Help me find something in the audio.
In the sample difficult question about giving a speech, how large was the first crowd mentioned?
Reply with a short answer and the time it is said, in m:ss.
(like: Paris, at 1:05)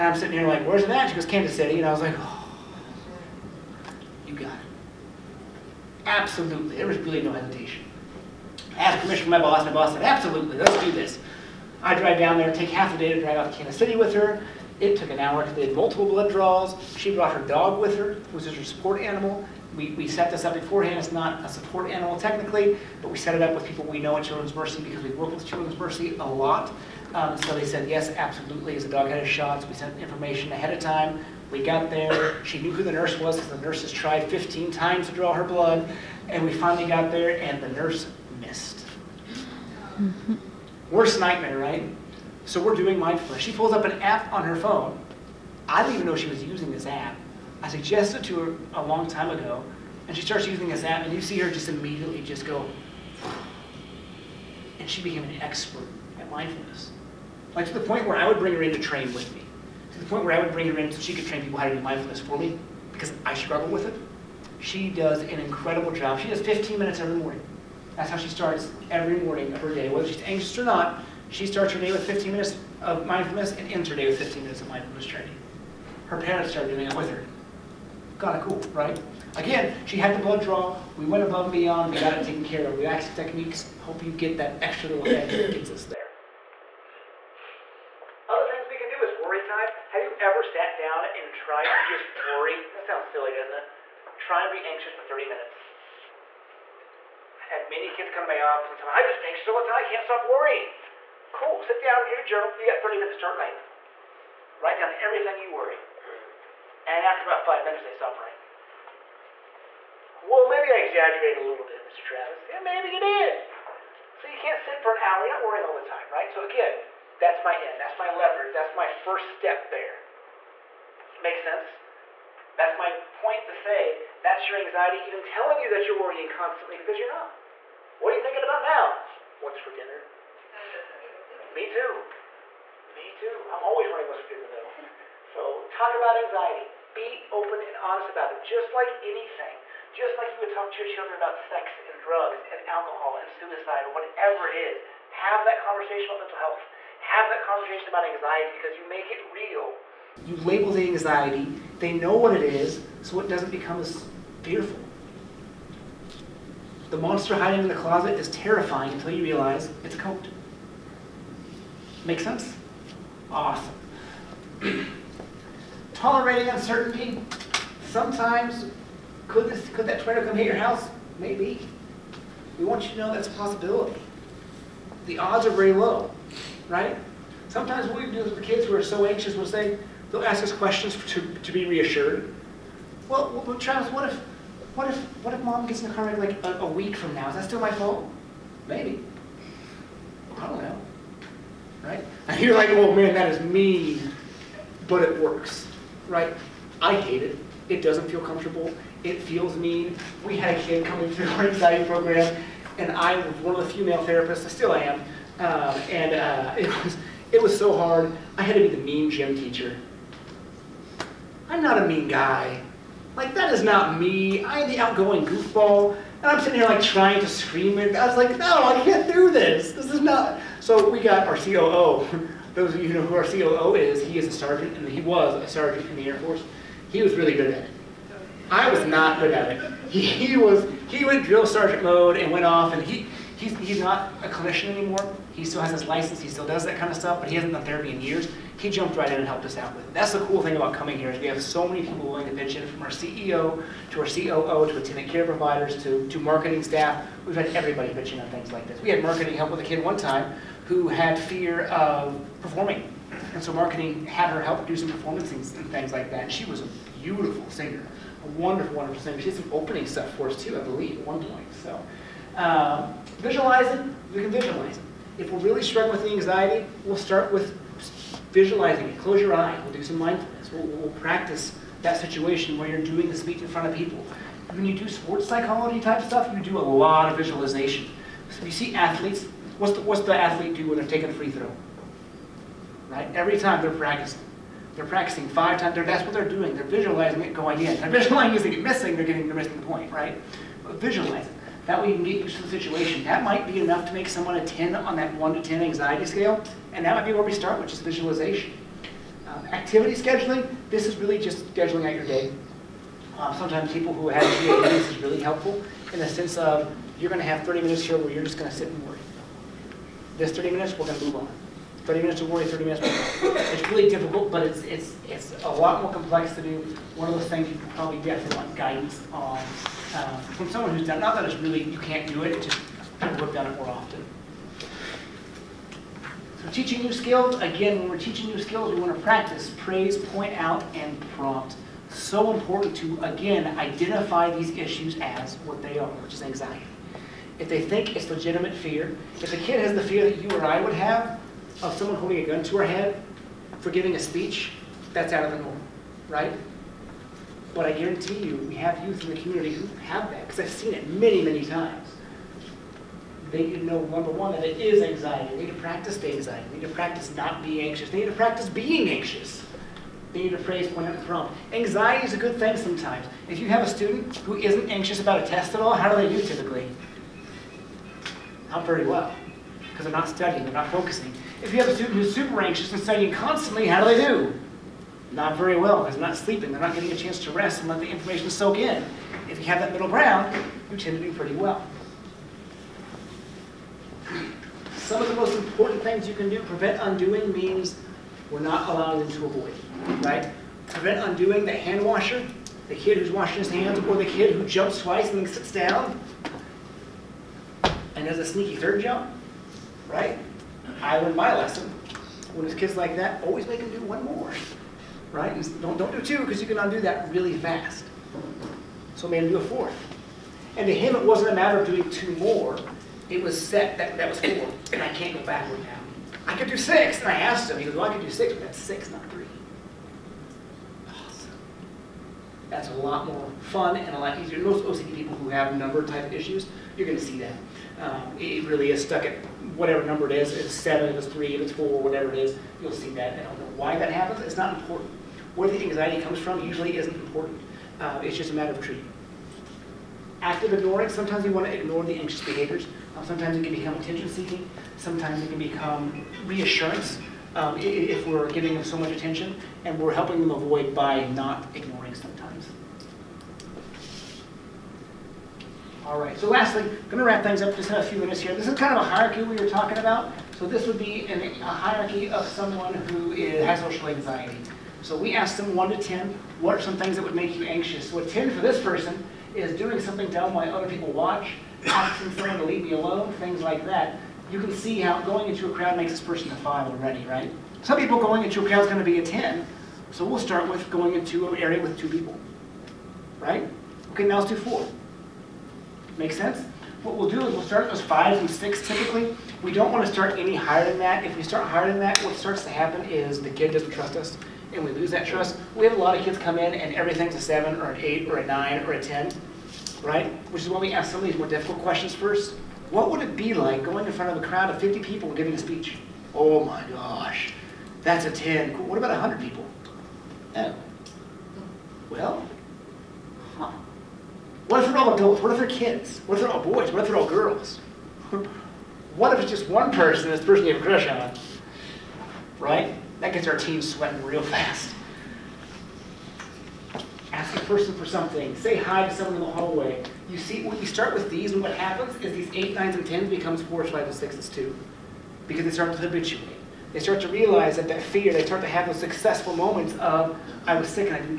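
50 people, at 8:24.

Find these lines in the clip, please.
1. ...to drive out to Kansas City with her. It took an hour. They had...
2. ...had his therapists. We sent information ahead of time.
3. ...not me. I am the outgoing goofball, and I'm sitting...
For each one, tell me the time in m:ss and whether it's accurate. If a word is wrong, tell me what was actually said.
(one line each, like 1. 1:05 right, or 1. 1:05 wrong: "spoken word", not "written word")
1. 0:13 right
2. 0:29 wrong: "shots", not "therapists"
3. 3:33 right.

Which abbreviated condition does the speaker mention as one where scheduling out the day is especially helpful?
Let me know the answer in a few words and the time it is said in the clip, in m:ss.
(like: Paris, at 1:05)
GAD, at 5:04.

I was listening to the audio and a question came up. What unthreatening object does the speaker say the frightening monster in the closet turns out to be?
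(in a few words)
A coat.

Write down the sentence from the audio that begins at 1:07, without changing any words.
That's how she starts every morning of her day, whether she's anxious or not.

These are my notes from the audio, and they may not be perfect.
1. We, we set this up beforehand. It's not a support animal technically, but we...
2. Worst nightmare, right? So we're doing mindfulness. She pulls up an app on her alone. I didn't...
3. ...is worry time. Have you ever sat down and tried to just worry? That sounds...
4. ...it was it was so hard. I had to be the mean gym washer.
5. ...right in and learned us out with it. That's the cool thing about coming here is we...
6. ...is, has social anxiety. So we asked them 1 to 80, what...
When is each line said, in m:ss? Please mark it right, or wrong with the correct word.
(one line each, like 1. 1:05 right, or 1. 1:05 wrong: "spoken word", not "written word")
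1. 0:19 right
2. 0:40 wrong: "phone", not "alone"
3. 1:29 right
4. 3:26 wrong: "teacher", not "washer"
5. 3:58 wrong: "helped", not "learned"
6. 7:43 wrong: "10", not "80".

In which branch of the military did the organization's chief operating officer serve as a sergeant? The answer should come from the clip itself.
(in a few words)
Air Force.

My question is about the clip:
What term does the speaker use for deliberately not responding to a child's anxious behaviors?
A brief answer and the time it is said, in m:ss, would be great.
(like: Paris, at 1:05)
Active ignoring, at 7:20.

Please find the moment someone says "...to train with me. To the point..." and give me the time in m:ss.
0:58.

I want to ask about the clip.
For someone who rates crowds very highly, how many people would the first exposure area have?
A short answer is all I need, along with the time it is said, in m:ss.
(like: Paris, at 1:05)
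2 people, at 8:01.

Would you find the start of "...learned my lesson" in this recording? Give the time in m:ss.
6:40.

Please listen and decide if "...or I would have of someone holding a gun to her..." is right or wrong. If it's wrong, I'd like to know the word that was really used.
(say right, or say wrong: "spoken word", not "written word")
right.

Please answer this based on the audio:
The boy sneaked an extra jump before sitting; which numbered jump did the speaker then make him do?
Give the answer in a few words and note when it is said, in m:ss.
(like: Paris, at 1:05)
A fourth, at 6:49.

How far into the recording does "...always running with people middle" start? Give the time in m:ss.
2:13.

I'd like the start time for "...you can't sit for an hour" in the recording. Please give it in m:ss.
1:54.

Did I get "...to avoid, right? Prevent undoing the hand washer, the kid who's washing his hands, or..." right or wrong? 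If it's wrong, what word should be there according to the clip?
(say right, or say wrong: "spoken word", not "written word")
right.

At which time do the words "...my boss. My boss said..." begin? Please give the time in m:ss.
0:09.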